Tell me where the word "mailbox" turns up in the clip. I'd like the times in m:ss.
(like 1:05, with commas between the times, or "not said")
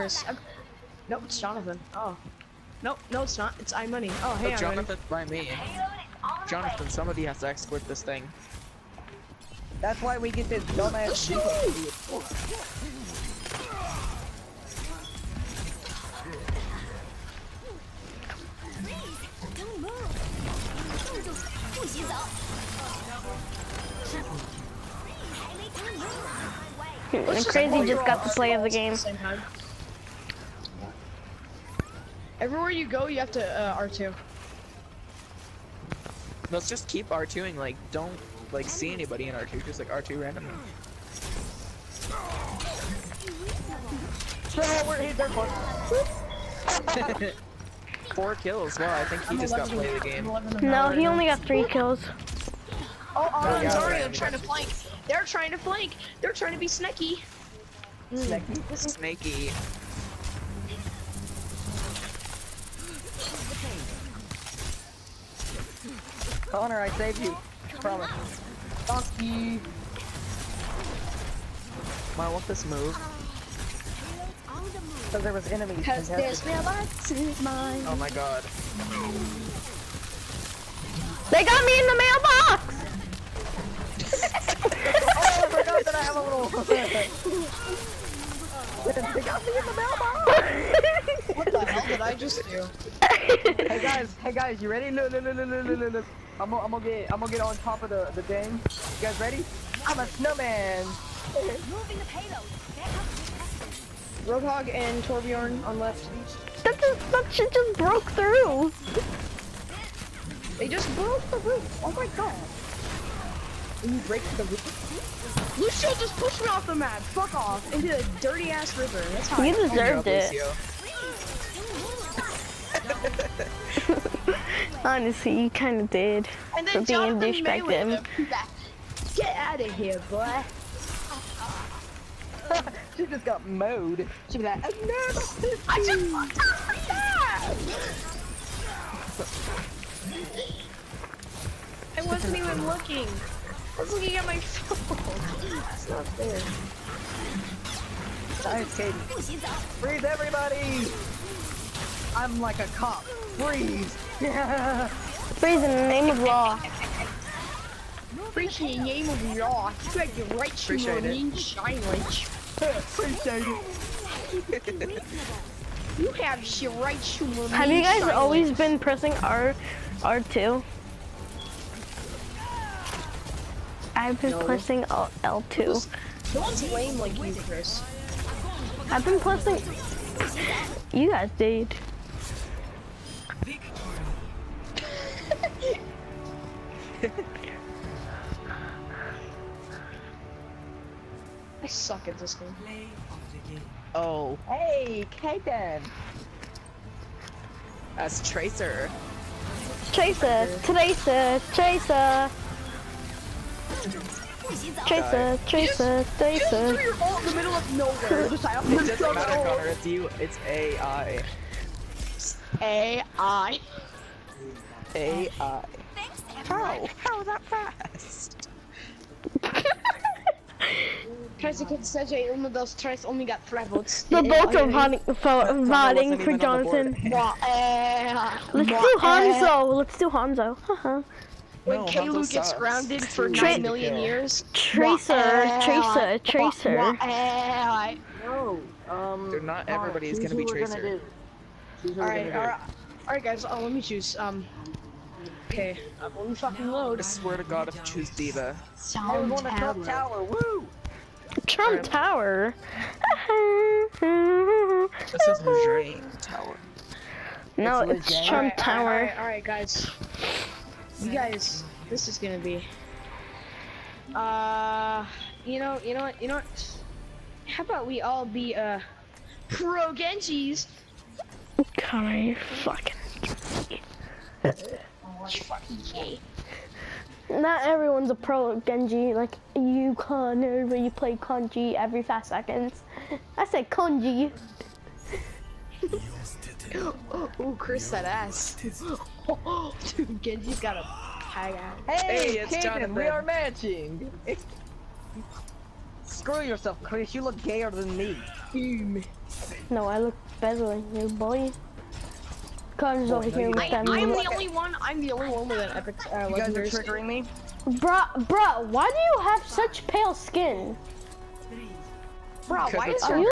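1:29.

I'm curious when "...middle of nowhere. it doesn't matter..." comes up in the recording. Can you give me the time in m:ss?
3:27.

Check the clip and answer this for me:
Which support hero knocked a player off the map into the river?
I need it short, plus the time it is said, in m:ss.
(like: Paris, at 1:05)
Lucio, at 1:55.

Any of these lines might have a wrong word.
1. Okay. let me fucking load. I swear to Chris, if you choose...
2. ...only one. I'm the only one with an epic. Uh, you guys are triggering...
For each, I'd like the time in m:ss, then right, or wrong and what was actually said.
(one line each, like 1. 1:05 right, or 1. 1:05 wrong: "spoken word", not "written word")
1. 4:05 wrong: "God", not "Chris"
2. 5:04 right.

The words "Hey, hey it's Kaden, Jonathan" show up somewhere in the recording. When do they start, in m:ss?
4:52.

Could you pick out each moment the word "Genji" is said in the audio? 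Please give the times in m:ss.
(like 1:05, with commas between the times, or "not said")
4:29, 4:38, 4:50.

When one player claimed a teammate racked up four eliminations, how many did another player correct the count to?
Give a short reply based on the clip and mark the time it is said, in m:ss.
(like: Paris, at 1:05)
3, at 0:51.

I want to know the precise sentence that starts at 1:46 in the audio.
That just, that shit just broke through.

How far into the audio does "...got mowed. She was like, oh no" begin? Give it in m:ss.
2:13.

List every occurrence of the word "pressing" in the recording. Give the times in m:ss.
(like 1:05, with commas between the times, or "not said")
2:48, 2:54, 2:59.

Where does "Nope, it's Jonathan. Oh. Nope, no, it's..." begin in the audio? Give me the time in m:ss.
0:01.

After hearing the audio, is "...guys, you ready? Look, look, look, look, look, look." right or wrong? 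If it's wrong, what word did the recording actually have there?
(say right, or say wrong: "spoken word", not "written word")
right.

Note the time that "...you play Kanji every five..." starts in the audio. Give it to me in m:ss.
4:40.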